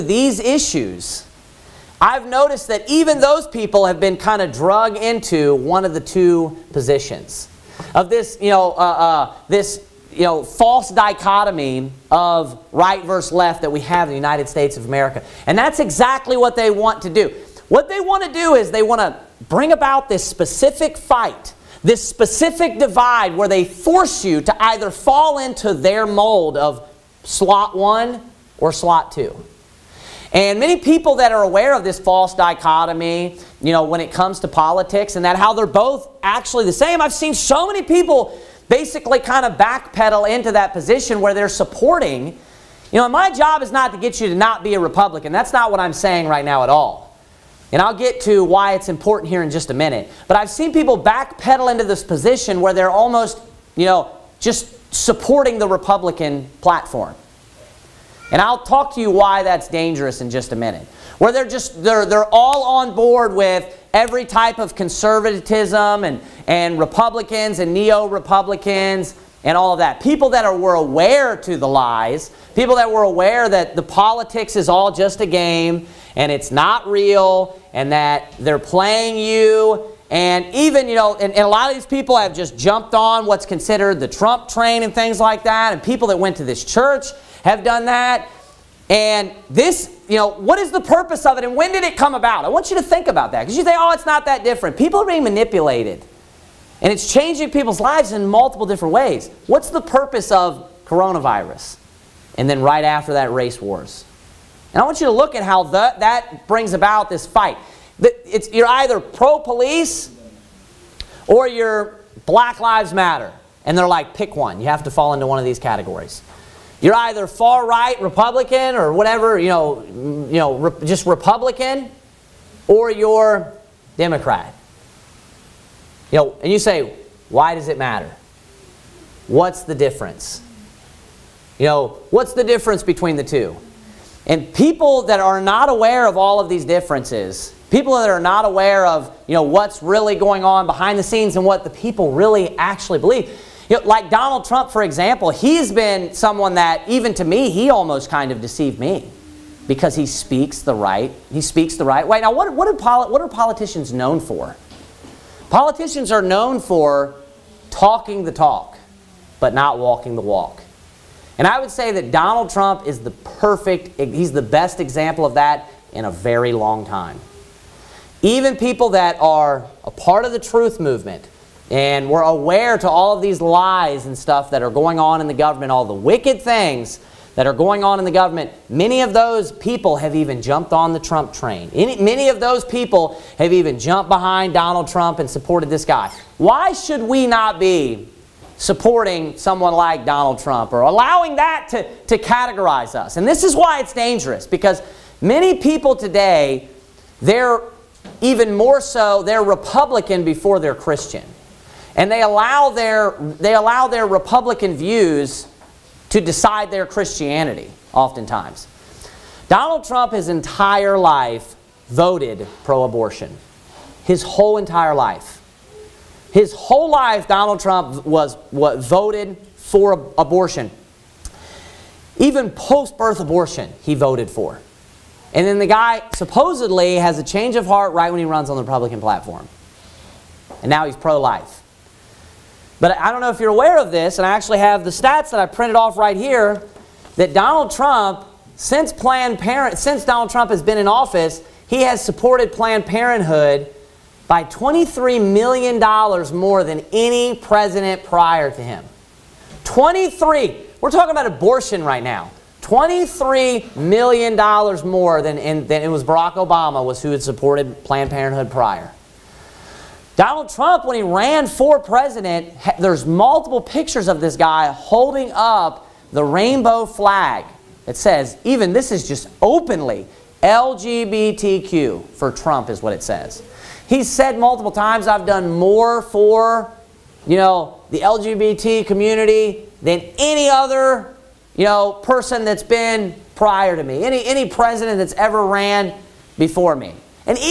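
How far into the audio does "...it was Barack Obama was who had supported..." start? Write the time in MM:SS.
04:15.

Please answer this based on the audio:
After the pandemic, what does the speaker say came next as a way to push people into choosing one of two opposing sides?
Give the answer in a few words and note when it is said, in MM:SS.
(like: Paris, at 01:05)
race wars, at 01:43.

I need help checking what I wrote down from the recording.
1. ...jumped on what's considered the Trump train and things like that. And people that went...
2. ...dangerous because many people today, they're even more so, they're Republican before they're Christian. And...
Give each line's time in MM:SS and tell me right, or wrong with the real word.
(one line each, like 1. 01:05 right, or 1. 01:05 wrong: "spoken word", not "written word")
1. 01:22 right
2. 03:13 right.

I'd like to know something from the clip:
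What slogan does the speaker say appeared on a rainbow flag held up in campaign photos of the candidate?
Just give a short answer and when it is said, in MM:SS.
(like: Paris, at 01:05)
LGBTQ for Trump, at 04:30.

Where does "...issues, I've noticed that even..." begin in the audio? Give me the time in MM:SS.
00:00.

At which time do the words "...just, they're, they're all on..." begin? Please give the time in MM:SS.
01:01.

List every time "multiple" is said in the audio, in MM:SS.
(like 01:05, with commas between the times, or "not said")
01:38, 04:23, 04:34.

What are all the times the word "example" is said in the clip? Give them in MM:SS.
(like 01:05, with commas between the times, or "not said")
02:24, 02:44.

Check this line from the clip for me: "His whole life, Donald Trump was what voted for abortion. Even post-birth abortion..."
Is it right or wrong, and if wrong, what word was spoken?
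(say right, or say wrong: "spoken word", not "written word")
right.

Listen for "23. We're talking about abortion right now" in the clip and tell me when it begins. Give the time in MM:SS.
04:09.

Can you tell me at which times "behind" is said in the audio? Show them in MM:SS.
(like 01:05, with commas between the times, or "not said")
02:20, 03:04.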